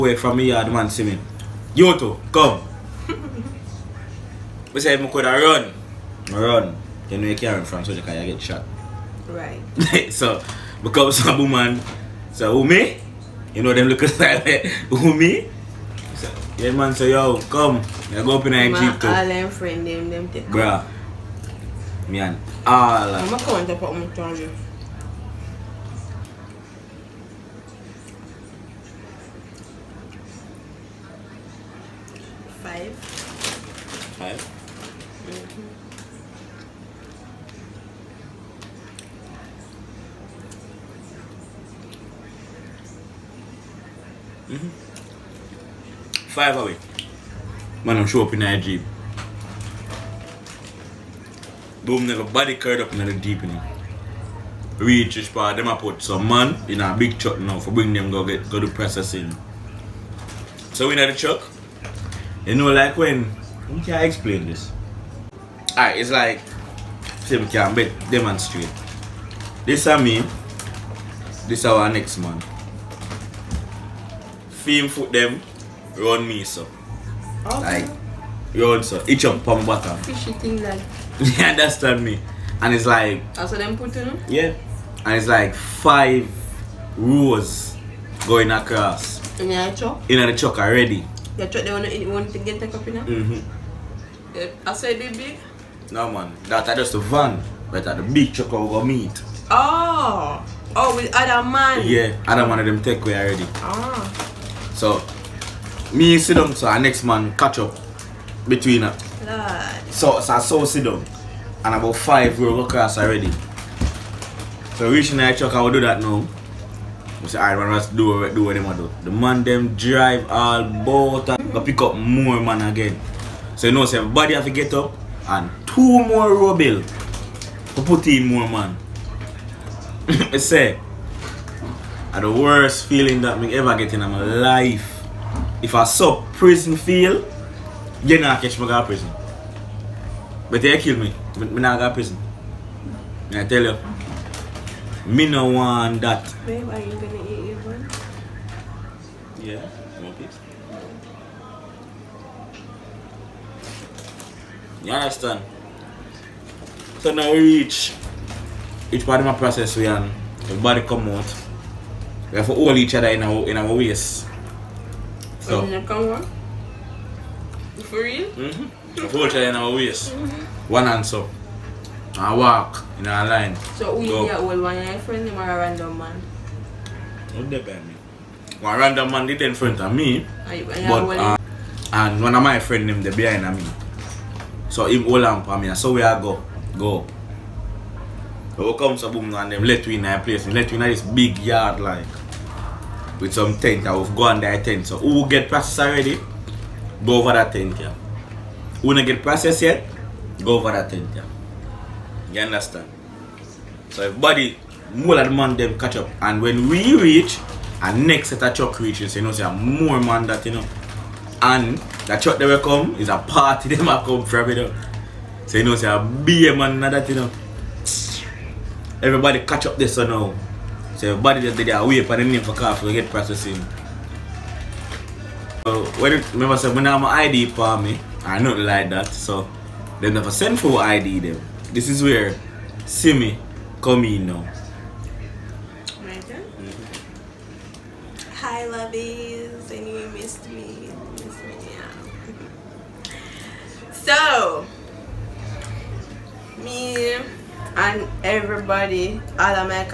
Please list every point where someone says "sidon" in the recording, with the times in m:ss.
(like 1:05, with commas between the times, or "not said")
1:46, 1:50.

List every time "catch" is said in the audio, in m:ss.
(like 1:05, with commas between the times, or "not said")
2:18, 3:25, 3:39.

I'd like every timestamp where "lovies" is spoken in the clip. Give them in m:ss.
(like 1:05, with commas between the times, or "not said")
3:58.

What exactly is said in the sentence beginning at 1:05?
Alright, it's like say we can demonstrate.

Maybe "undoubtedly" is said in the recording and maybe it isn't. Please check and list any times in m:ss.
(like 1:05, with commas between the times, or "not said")
not said.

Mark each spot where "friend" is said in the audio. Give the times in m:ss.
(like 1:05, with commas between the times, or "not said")
0:19, 2:54, 3:02.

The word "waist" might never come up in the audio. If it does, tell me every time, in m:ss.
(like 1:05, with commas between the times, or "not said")
2:43, 2:49.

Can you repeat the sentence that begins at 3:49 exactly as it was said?
So they never send for ID them.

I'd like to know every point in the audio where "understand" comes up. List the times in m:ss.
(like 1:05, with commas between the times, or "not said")
1:21, 2:34, 3:22.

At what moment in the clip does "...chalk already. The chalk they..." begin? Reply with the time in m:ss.
1:30.